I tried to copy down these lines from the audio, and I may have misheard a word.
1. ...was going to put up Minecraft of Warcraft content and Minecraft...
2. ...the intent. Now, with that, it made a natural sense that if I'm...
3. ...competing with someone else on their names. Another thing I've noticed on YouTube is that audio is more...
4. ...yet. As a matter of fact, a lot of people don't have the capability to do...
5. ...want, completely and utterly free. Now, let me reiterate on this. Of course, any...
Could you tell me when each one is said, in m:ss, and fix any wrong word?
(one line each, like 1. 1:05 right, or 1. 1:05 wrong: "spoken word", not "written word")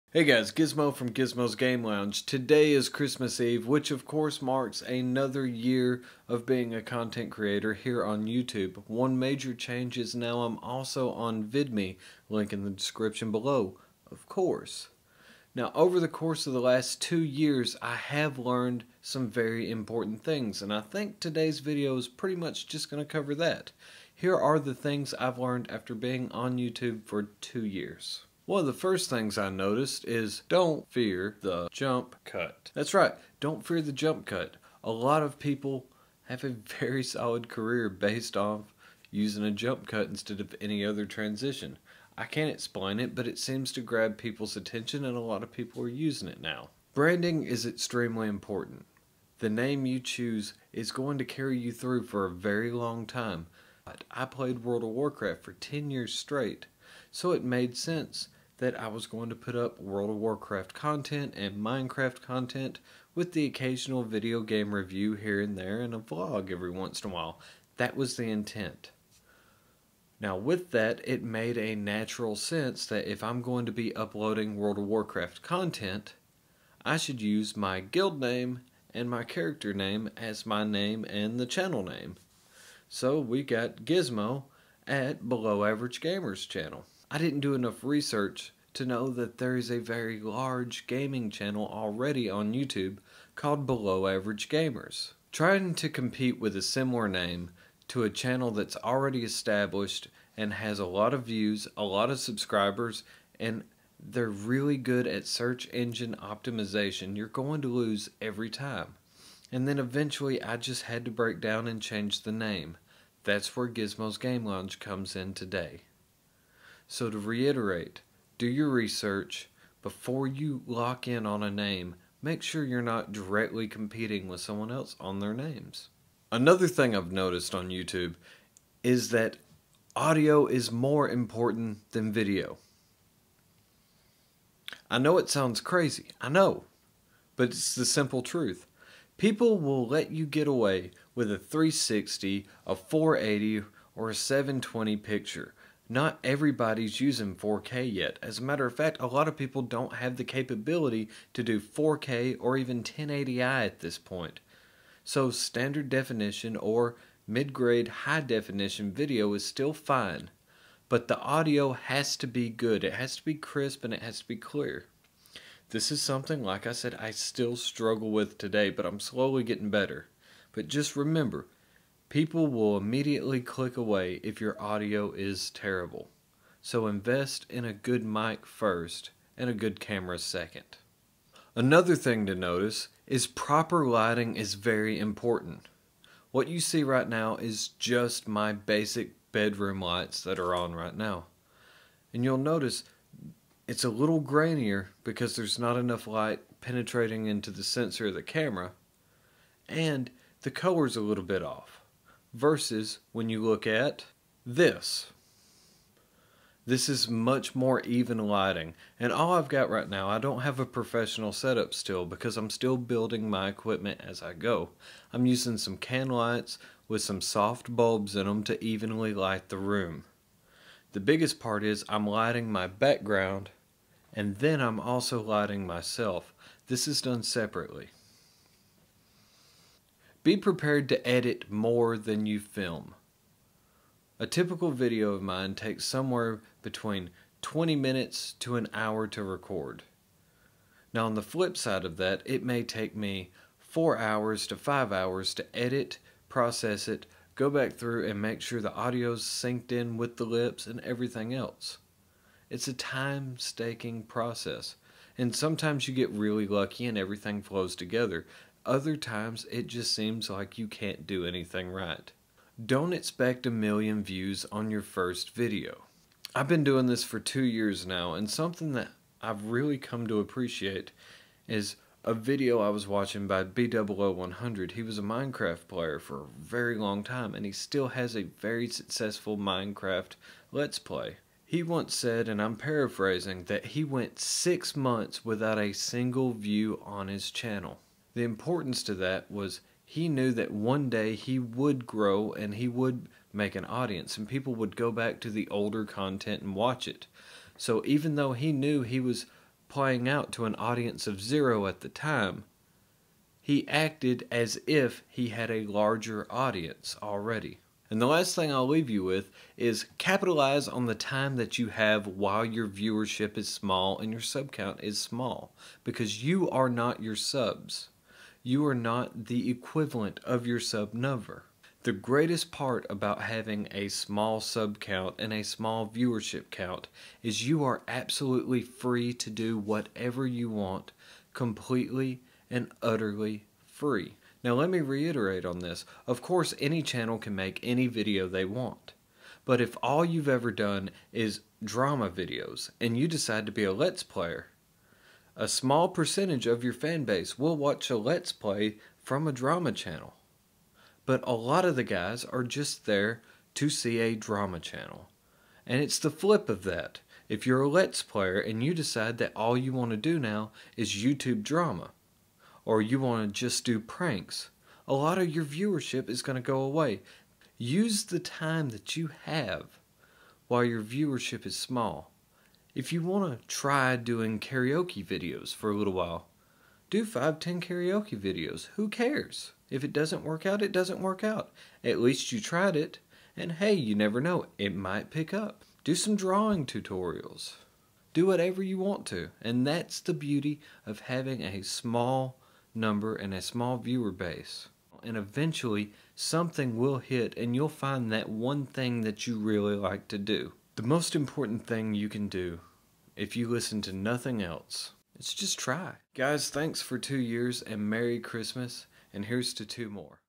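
1. 0:58 wrong: "World", not "Minecraft"
2. 1:08 right
3. 2:03 right
4. 2:27 right
5. 5:30 right.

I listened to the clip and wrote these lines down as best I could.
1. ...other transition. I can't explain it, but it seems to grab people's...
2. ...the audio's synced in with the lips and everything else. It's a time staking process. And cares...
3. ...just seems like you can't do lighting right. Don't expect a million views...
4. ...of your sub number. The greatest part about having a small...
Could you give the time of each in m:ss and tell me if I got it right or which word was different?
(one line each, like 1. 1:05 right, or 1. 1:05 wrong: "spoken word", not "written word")
1. 0:40 right
2. 4:08 wrong: "sometimes", not "cares"
3. 4:19 wrong: "anything", not "lighting"
4. 5:20 right.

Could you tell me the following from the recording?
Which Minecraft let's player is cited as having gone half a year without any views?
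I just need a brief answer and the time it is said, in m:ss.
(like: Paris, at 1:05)
BdoubleO100, at 4:33.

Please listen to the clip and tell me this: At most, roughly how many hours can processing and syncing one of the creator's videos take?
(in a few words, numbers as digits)
5.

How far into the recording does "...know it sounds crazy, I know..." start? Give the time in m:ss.
2:14.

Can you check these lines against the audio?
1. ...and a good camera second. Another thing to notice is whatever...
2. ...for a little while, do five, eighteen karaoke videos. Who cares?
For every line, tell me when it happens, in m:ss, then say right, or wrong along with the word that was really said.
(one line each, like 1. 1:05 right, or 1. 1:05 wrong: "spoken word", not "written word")
1. 2:59 wrong: "proper", not "whatever"
2. 6:15 wrong: "ten", not "eighteen".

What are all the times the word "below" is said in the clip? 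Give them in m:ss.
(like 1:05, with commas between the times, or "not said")
0:13, 1:25, 1:33.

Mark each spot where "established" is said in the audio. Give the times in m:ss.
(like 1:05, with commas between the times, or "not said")
1:39.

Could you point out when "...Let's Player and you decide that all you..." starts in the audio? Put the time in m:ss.
5:57.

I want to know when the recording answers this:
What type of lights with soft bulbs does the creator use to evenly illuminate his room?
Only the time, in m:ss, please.
3:35.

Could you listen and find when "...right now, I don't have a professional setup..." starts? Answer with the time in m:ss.
3:29.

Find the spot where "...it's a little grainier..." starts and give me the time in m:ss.
3:13.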